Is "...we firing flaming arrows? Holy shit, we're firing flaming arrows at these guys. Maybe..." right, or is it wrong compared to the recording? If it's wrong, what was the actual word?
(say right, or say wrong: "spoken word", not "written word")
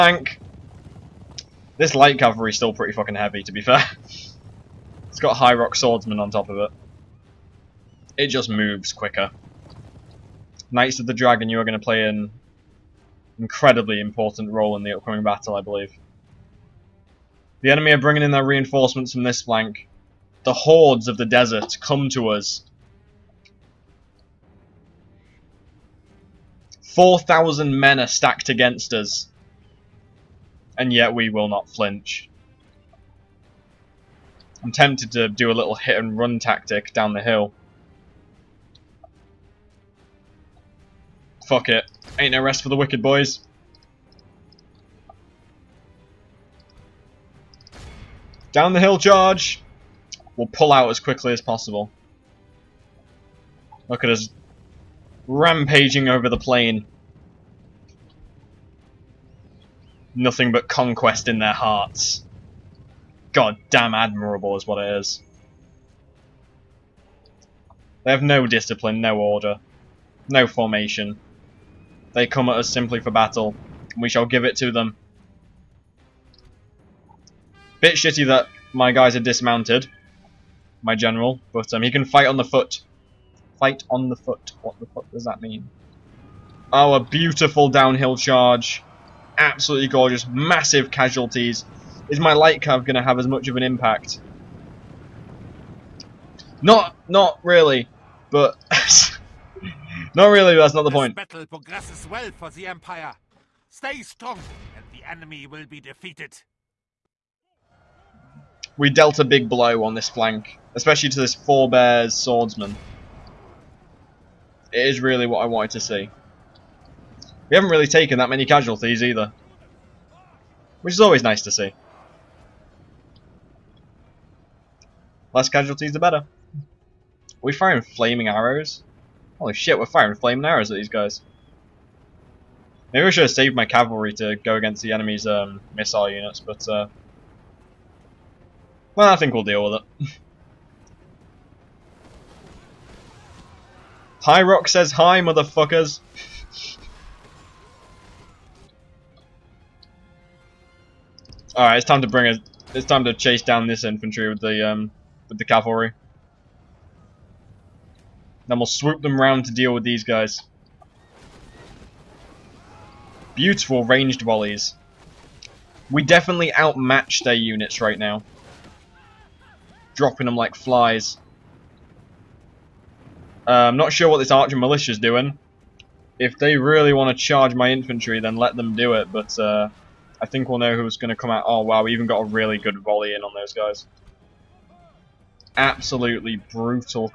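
right.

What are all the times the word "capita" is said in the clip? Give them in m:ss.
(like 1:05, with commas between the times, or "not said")
not said.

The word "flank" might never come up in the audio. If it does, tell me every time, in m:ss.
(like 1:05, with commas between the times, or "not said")
0:19, 1:50.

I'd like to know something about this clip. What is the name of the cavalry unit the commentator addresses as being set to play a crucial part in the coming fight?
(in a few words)
Knights of the Dragon.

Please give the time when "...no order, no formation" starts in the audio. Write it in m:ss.
1:09.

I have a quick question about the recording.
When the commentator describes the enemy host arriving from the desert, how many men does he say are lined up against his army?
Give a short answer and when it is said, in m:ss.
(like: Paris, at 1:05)
4,000, at 0:26.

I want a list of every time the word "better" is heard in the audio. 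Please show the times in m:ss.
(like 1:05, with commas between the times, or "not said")
2:05.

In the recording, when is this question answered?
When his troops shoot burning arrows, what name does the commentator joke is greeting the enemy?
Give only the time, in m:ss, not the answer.
2:24.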